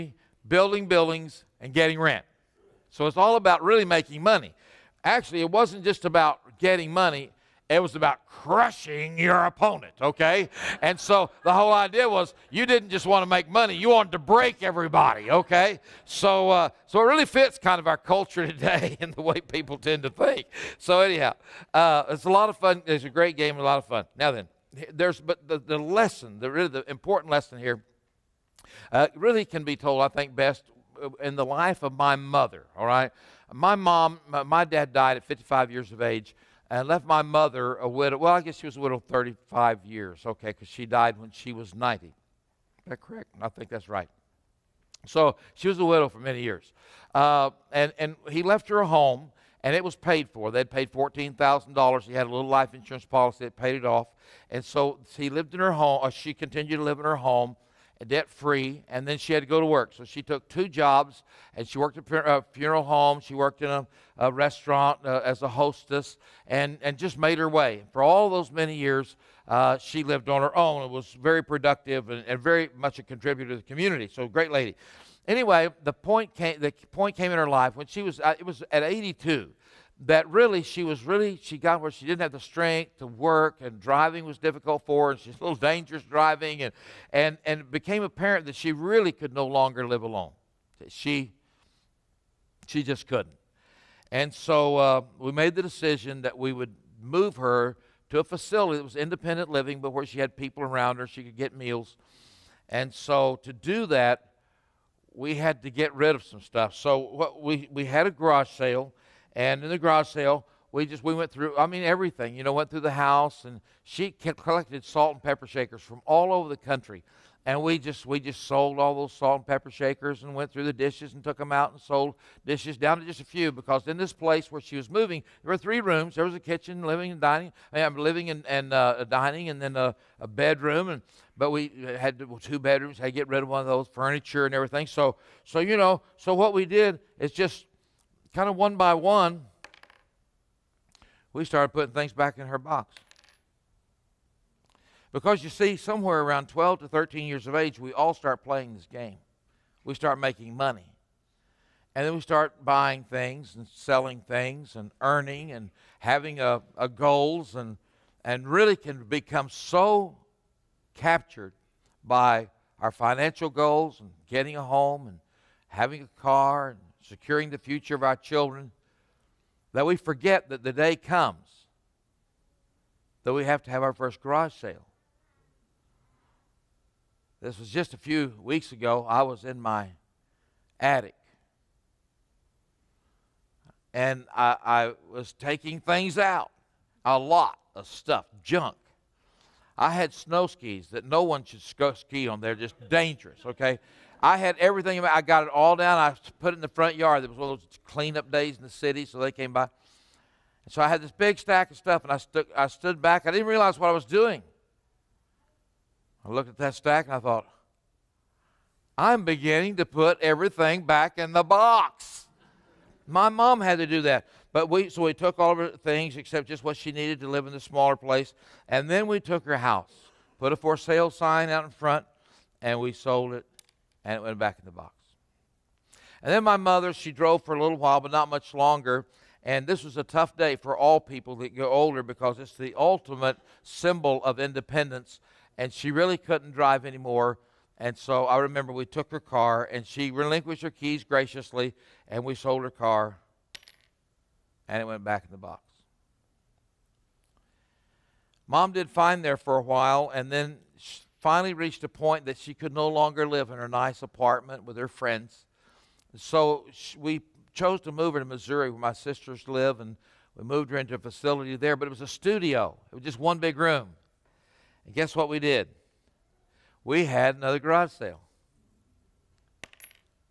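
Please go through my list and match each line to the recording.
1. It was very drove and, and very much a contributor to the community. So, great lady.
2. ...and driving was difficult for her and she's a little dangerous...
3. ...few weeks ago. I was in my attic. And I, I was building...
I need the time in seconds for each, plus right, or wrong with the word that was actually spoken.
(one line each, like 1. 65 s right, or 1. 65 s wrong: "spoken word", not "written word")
1. 70 s wrong: "productive", not "drove"
2. 83 s right
3. 177 s wrong: "taking", not "building".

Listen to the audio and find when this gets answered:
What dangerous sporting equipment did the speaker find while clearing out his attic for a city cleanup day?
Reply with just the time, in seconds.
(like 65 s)
190 s.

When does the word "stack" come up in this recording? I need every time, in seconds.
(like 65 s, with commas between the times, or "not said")
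201 s, 206 s.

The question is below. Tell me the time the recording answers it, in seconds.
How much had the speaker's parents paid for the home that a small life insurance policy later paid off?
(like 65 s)
50 s.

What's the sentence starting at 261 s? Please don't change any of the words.
But it was a studio, it was just one big room.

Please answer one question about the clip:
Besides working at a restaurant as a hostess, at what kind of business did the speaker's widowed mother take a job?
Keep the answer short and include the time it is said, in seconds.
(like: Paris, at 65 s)
Funeral home, at 62 s.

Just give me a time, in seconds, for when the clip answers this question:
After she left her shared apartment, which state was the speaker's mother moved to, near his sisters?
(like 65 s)
258 s.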